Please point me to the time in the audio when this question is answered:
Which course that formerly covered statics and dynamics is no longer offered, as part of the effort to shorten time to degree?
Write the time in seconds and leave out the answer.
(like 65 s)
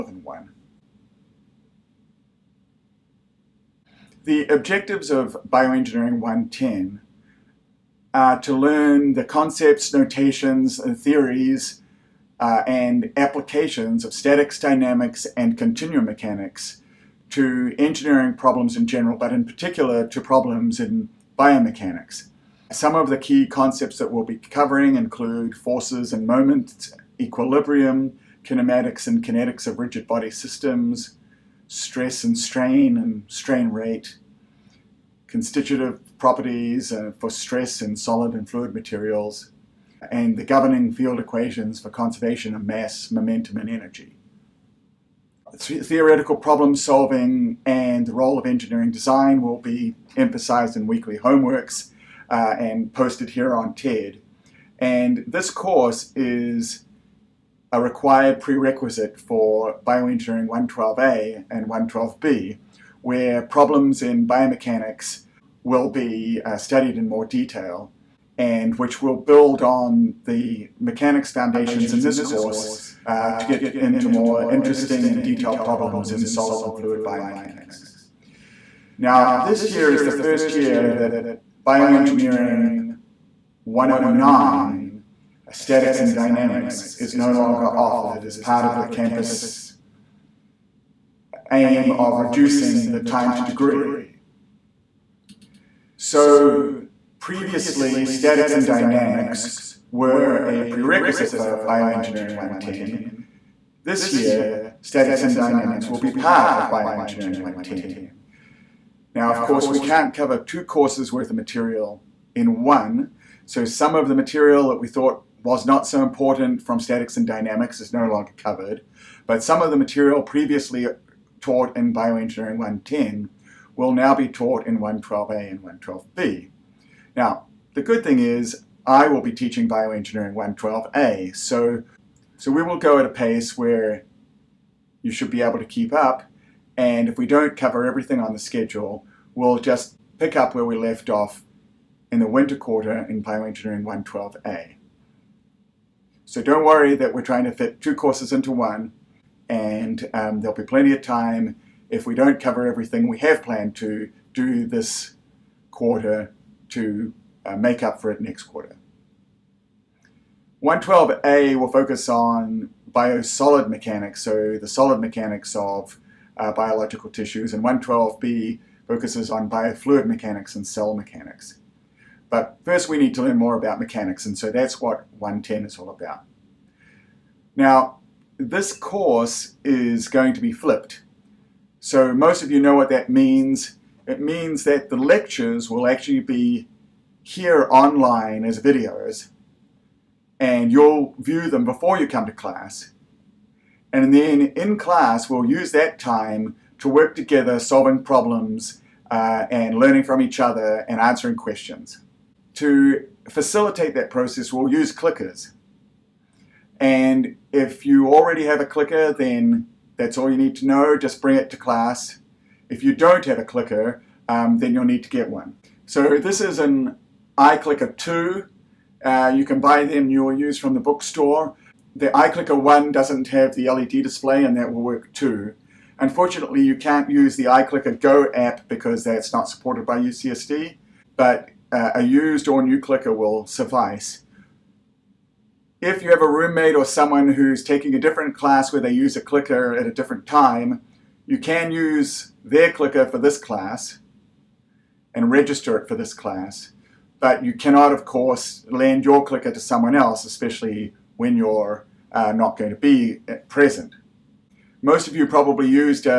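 81 s.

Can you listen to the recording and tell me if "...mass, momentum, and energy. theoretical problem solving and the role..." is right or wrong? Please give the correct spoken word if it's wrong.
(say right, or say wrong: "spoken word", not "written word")
right.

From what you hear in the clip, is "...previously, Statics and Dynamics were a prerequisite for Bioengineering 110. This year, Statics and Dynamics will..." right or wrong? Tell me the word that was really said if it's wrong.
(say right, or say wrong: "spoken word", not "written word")
right.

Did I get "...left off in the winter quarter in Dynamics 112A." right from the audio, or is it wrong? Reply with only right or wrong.
wrong.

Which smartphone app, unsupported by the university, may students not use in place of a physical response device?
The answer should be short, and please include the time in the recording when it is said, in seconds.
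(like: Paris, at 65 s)
iClicker Go app, at 227 s.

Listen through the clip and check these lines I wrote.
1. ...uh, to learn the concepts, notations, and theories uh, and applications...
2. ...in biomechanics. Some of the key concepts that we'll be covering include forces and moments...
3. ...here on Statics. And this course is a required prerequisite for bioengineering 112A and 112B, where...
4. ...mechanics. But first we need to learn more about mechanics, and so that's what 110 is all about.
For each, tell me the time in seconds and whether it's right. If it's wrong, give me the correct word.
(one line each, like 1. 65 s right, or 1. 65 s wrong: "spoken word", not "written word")
1. 8 s right
2. 20 s right
3. 53 s wrong: "TED", not "Statics"
4. 170 s right.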